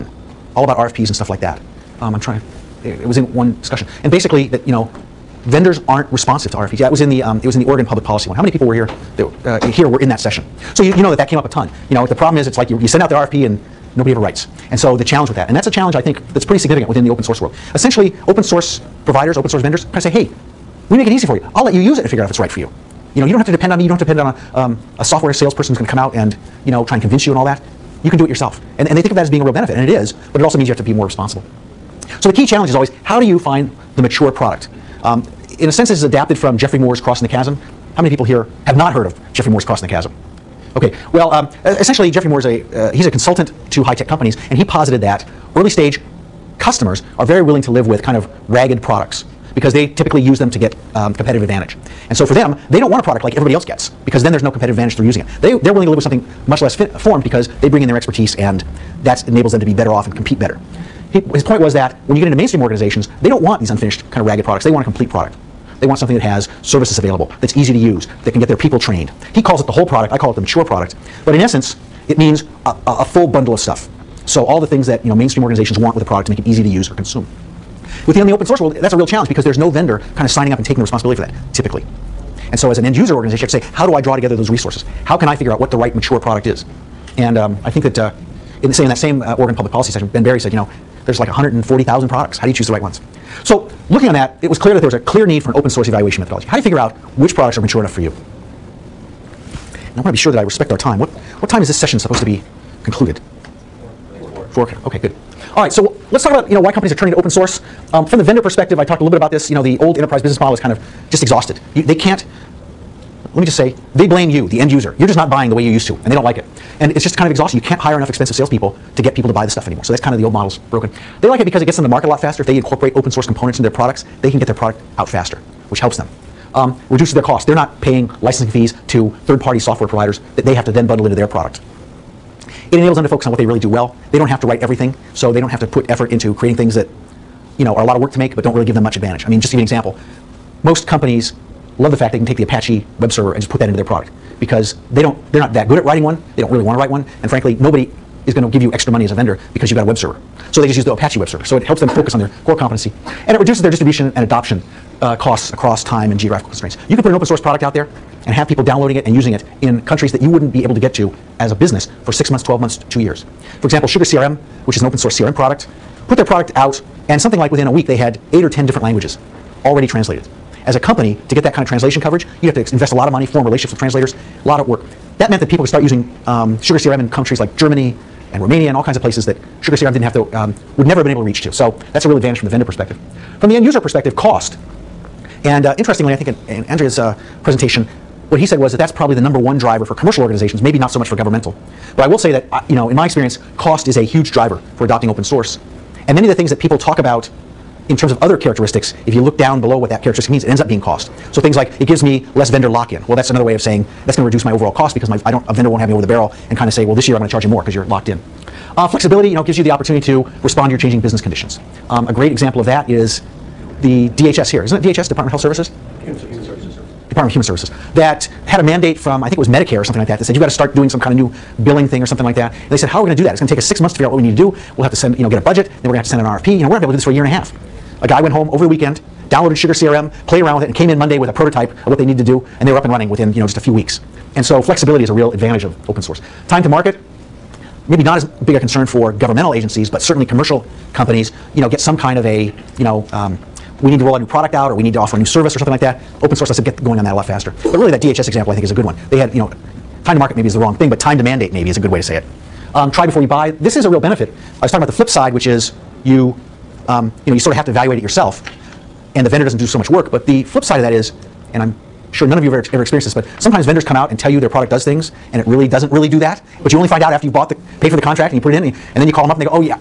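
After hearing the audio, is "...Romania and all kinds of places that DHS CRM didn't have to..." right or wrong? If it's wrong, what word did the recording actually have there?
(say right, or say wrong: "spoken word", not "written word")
wrong: "Sugar", not "DHS".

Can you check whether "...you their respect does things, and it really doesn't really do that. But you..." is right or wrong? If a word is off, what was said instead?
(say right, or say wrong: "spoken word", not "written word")
wrong: "product", not "respect".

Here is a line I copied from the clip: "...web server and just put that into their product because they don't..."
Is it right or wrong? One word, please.
right.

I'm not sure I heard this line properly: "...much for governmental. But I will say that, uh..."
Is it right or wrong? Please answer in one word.
right.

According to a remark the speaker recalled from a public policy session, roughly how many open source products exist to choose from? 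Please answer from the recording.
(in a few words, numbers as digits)
140,000.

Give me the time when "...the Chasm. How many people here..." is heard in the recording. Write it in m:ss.
0:37.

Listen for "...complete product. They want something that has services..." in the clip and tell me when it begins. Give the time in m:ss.
1:04.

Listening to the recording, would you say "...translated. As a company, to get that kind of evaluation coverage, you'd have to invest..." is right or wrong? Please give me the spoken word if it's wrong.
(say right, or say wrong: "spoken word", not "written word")
wrong: "translation", not "evaluation".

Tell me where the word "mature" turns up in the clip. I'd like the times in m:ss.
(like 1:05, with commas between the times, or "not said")
0:34, 1:10, 1:25, 1:37.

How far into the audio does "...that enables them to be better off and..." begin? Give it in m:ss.
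0:59.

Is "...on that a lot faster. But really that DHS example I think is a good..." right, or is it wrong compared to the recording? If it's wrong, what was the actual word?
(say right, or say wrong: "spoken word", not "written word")
right.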